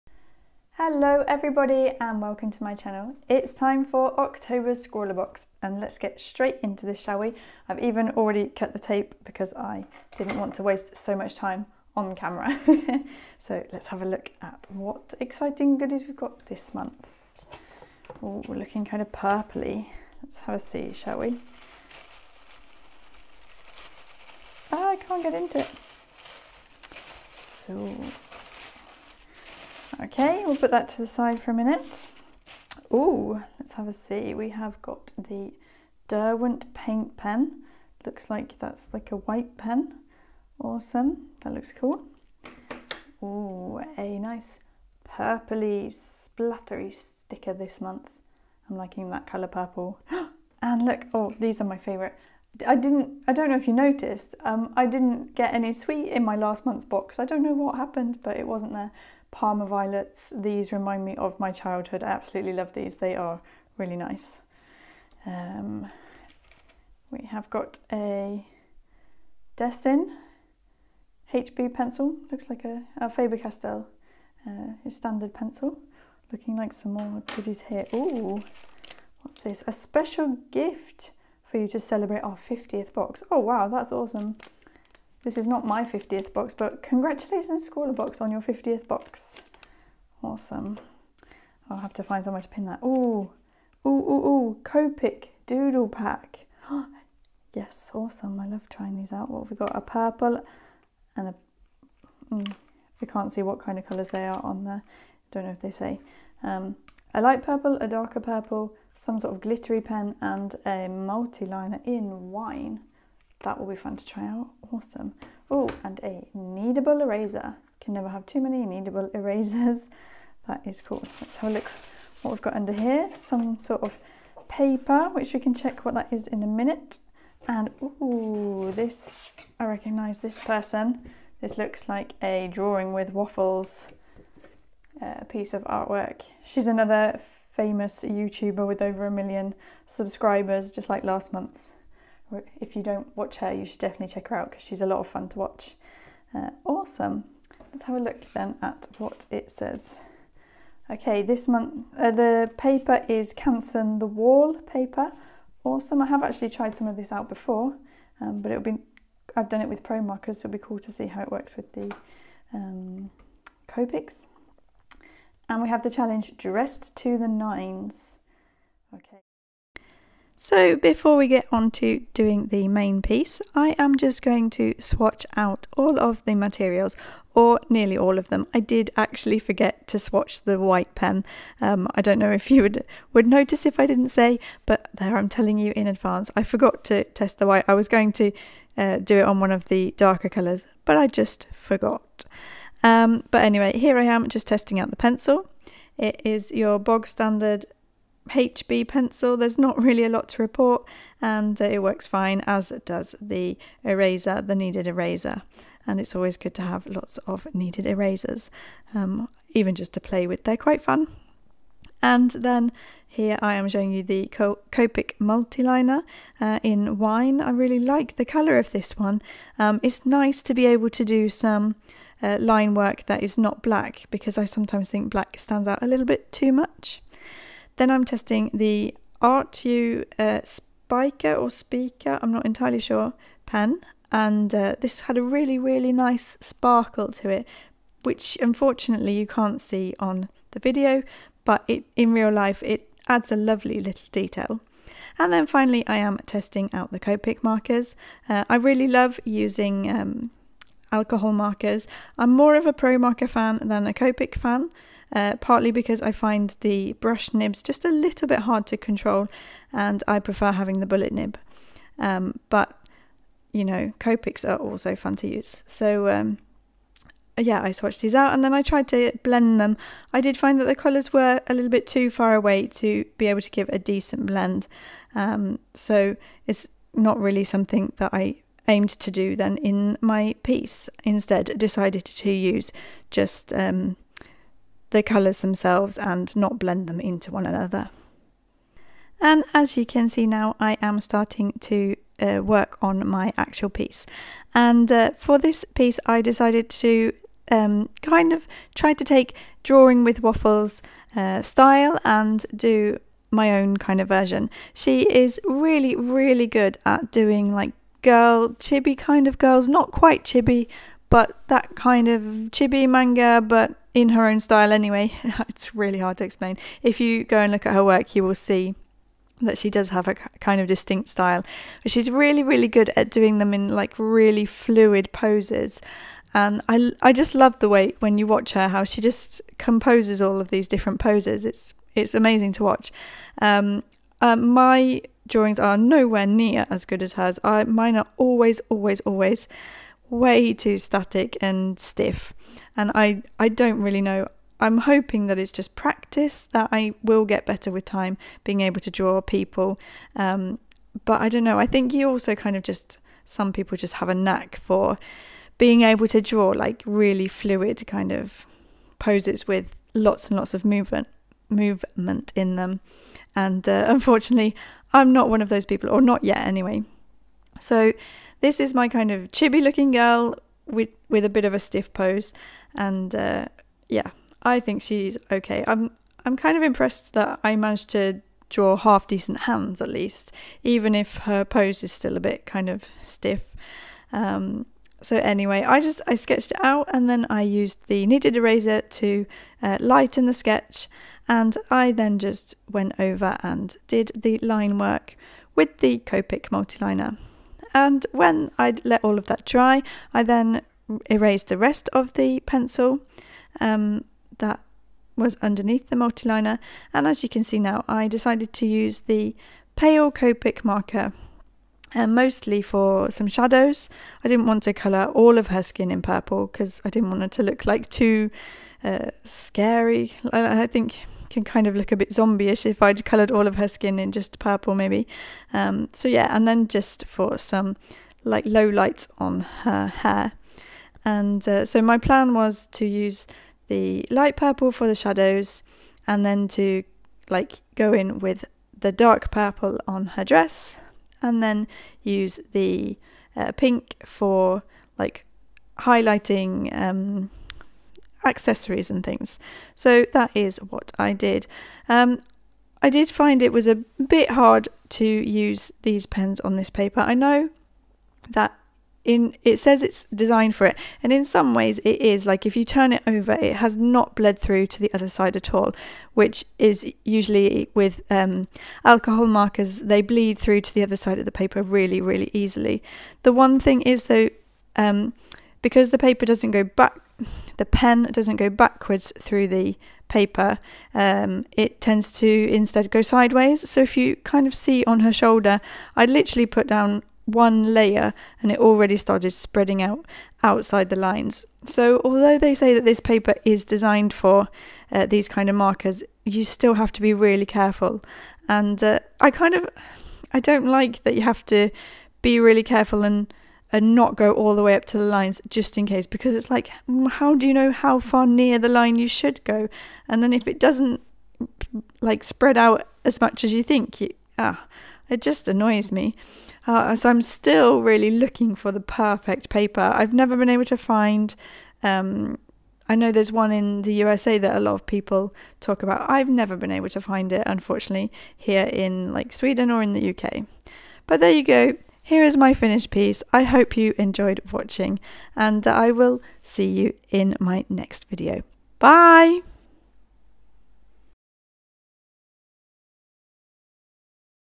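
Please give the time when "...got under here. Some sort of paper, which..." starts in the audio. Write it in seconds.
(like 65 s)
122 s.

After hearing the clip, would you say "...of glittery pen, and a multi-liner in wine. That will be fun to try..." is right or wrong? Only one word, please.
right.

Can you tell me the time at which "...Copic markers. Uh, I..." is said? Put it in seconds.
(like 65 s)
246 s.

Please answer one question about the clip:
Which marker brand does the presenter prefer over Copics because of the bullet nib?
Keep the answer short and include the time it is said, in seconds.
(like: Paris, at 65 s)
Pro Marker, at 252 s.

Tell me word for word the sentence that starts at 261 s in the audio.
Um, but, you know, Copics are also fun to use.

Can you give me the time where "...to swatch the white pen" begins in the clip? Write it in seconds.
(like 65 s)
179 s.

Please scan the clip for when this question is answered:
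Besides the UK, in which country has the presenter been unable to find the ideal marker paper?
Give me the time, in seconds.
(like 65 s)
529 s.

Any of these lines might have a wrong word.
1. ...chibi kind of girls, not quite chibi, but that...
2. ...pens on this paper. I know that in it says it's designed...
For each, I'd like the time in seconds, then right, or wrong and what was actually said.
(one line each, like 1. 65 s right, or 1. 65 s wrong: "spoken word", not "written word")
1. 308 s right
2. 456 s right.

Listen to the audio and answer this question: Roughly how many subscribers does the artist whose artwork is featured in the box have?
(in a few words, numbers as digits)
Over a million.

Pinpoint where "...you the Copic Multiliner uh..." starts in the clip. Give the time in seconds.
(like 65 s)
213 s.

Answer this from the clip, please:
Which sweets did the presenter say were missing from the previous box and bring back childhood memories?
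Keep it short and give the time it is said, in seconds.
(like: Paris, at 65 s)
Parma violets, at 59 s.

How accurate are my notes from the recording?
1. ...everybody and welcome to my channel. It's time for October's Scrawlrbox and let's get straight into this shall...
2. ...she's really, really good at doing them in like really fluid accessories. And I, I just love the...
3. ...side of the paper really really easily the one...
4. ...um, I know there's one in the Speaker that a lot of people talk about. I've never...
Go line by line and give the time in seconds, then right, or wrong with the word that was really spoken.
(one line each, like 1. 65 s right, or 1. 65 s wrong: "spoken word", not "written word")
1. 1 s right
2. 321 s wrong: "poses", not "accessories"
3. 470 s right
4. 521 s wrong: "USA", not "Speaker".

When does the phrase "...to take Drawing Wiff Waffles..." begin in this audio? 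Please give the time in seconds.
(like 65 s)
298 s.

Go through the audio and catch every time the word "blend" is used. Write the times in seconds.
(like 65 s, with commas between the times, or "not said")
269 s, 274 s, 286 s.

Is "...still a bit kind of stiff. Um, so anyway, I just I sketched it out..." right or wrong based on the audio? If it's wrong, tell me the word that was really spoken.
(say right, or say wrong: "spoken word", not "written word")
right.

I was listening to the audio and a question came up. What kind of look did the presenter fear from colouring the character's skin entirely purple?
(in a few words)
Zombie-ish.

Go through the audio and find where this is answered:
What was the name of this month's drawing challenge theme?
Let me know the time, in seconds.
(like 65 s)
166 s.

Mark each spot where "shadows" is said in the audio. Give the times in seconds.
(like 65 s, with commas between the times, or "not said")
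413 s, 434 s.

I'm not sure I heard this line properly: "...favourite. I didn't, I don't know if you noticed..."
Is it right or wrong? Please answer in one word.
right.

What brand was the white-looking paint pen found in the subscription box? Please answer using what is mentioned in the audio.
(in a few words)
Derwent.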